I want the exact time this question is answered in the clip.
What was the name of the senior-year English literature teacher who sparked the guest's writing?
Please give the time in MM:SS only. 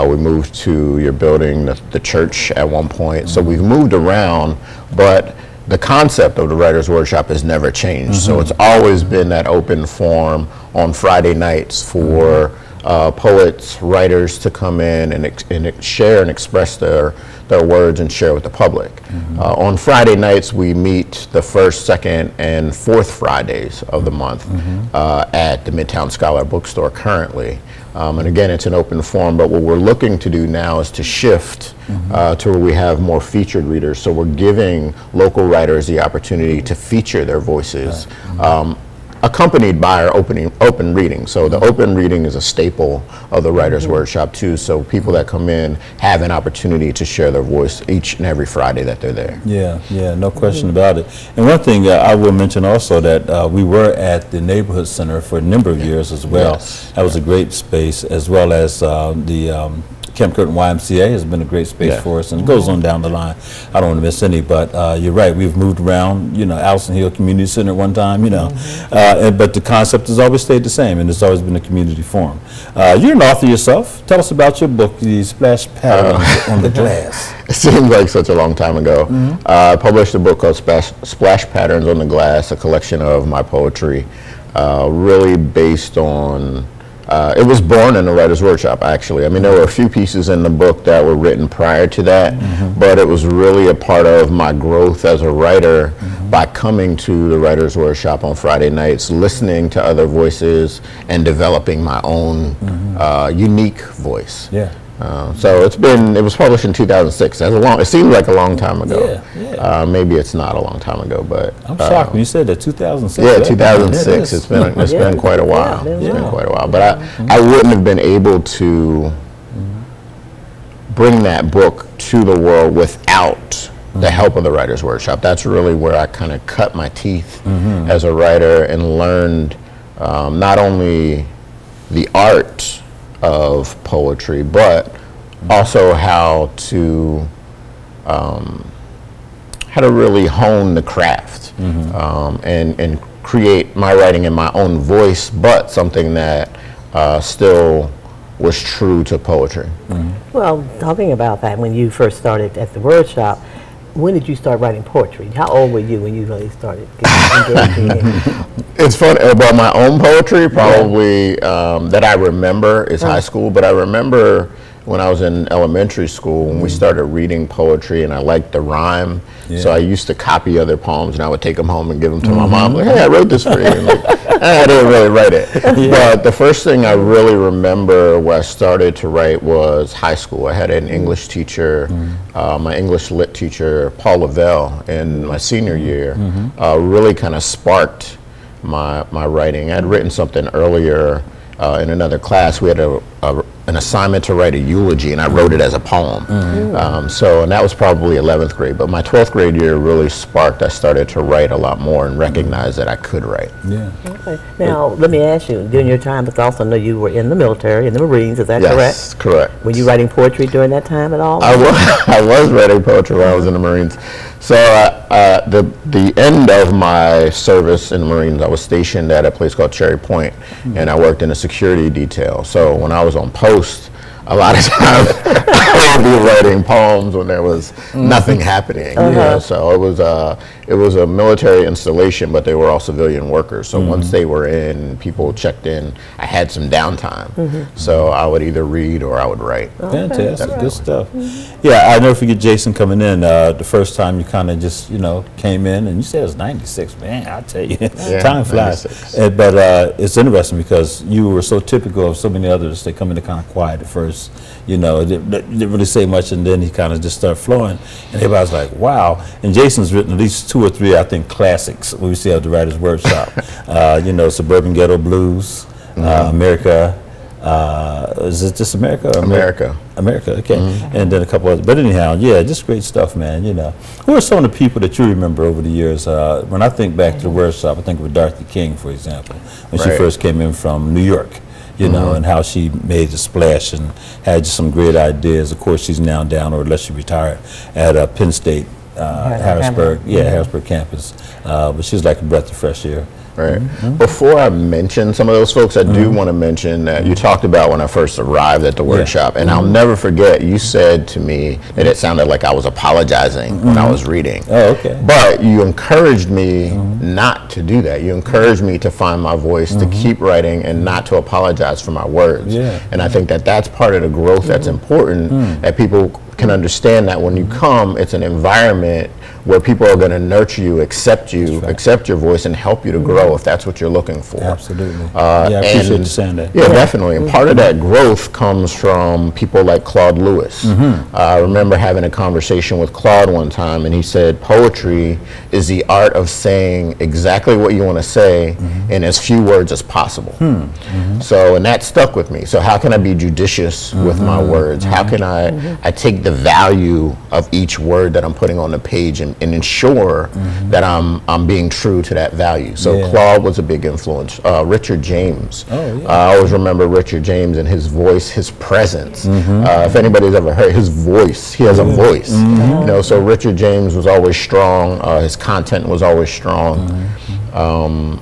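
03:03.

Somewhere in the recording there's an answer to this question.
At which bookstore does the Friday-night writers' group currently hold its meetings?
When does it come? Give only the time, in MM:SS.
00:25.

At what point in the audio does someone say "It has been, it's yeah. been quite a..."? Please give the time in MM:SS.
01:54.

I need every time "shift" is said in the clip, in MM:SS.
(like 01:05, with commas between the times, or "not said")
00:31.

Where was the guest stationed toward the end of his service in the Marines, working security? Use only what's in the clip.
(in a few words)
Cherry Point.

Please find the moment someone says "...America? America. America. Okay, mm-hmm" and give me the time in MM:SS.
04:28.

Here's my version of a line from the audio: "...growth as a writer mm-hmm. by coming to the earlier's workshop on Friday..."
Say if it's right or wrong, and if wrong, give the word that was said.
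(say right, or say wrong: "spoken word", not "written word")
wrong: "writer", not "earlier".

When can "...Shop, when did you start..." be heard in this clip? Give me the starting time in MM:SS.
02:33.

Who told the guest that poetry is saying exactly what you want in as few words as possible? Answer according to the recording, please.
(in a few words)
Claude Lewis.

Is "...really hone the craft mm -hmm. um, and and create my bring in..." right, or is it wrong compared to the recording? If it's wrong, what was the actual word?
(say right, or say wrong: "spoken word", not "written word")
wrong: "writing", not "bring".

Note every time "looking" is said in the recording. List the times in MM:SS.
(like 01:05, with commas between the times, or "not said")
00:29, 05:23.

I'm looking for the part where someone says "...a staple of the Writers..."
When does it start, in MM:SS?
00:42.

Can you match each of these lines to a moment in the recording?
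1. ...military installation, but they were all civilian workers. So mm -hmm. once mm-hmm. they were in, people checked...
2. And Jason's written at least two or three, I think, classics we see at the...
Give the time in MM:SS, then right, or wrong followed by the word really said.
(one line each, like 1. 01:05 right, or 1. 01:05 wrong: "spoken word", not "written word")
1. 03:51 right
2. 04:19 right.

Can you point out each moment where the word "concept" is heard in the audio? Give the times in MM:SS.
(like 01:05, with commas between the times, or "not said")
00:05, 01:09.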